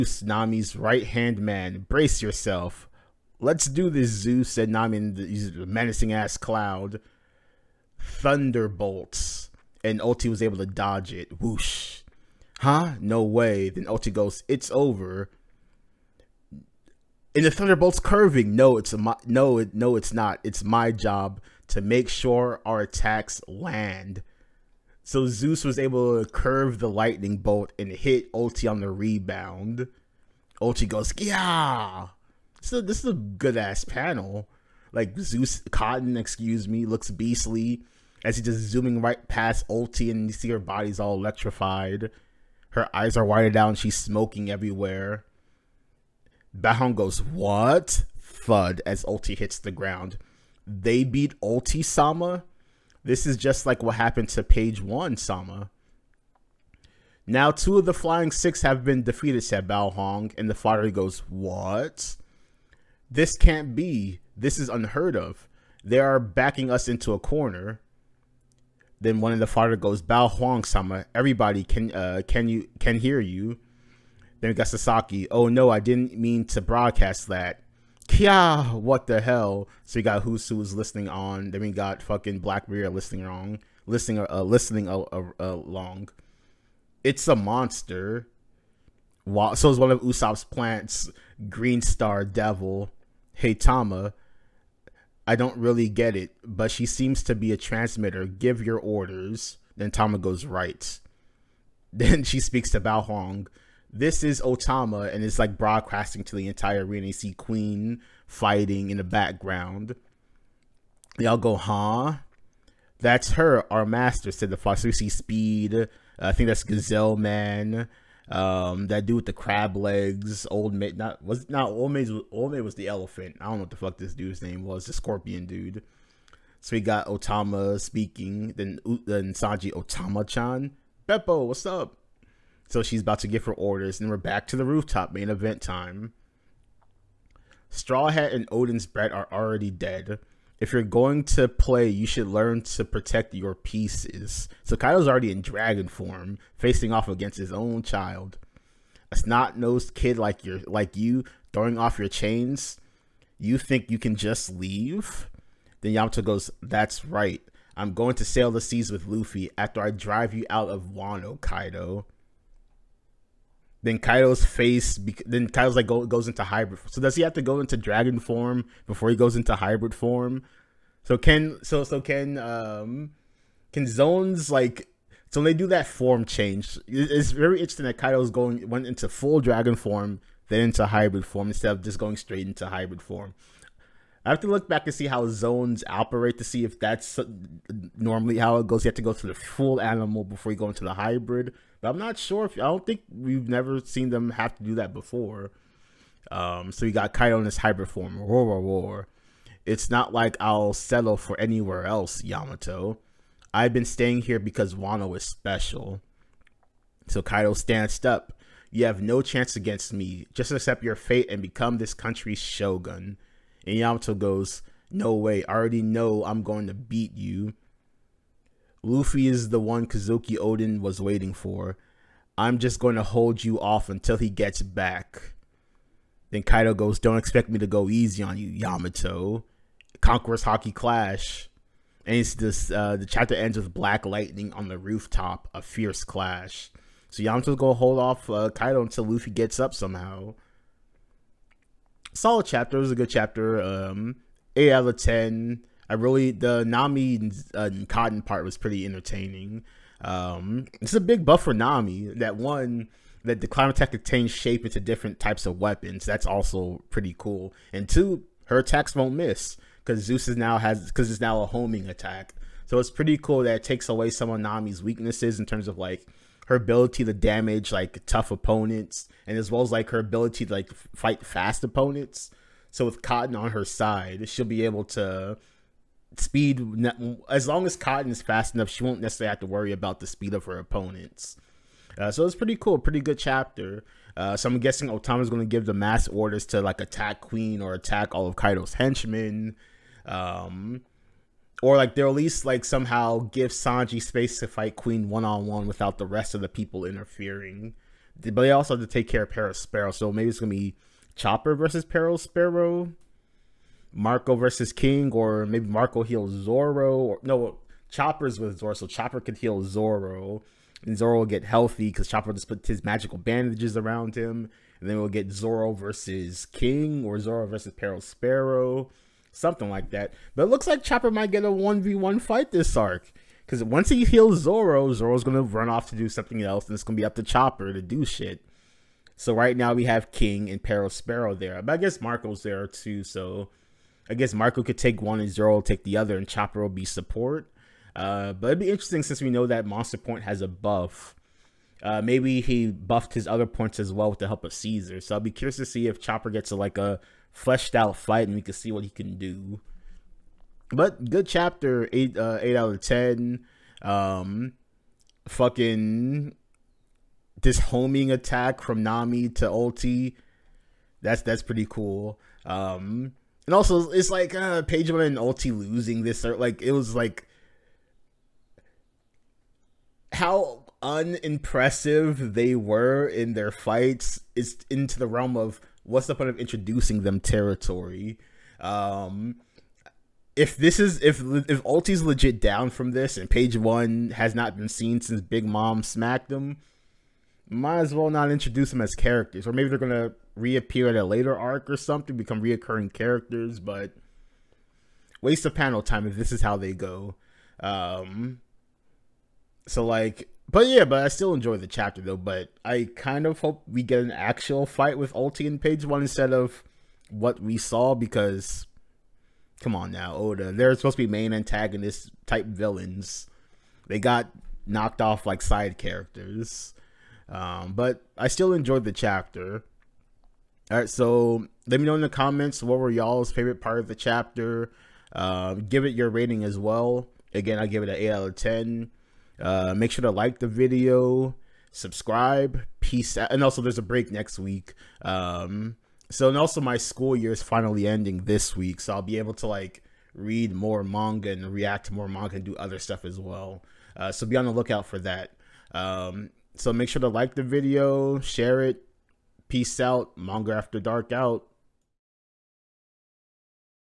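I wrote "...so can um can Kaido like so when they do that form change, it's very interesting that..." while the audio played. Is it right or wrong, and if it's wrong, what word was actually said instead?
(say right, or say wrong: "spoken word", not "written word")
wrong: "Zoans", not "Kaido".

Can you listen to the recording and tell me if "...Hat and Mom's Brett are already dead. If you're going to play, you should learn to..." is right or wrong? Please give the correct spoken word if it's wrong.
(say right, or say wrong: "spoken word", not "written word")
wrong: "Oden", not "Mom".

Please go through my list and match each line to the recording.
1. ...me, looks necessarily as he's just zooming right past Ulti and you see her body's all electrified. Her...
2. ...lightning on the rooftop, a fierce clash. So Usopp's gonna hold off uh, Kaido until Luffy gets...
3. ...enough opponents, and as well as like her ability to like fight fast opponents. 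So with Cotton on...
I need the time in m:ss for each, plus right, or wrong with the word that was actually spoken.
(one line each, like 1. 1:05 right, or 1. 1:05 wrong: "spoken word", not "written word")
1. 0:36 wrong: "beastly", not "necessarily"
2. 3:54 wrong: "Yamato", not "Usopp"
3. 4:28 wrong: "tough", not "enough".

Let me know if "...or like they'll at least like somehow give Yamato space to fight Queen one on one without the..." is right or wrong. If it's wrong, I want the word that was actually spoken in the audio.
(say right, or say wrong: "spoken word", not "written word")
wrong: "Sanji", not "Yamato".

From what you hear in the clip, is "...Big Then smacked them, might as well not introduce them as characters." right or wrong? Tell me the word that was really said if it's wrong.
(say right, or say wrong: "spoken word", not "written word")
wrong: "Mom", not "Then".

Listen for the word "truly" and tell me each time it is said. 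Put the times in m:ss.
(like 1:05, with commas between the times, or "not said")
not said.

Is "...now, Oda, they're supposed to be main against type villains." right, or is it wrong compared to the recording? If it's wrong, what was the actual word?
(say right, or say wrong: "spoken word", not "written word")
wrong: "antagonist", not "against".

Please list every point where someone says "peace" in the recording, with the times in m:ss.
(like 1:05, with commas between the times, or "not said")
7:12, 7:29.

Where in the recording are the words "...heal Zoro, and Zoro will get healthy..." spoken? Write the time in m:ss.
5:09.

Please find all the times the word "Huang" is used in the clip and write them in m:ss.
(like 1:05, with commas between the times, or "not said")
0:46, 0:59, 1:10, 1:43.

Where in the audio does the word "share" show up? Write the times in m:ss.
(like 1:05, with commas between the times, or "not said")
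7:28.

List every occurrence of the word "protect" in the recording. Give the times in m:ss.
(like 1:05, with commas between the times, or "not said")
2:22.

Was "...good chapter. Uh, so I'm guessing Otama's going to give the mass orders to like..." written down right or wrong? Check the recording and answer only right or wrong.
right.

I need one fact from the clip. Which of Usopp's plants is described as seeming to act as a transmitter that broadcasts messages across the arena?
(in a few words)
Green Star Devil.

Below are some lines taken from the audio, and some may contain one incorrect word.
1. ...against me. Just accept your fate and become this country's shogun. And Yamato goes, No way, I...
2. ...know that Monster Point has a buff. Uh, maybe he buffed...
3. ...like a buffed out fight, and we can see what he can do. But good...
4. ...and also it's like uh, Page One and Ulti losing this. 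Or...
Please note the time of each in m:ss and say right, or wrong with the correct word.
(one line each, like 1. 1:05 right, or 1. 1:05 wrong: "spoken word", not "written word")
1. 3:29 right
2. 5:39 right
3. 5:46 wrong: "fleshed", not "buffed"
4. 6:03 right.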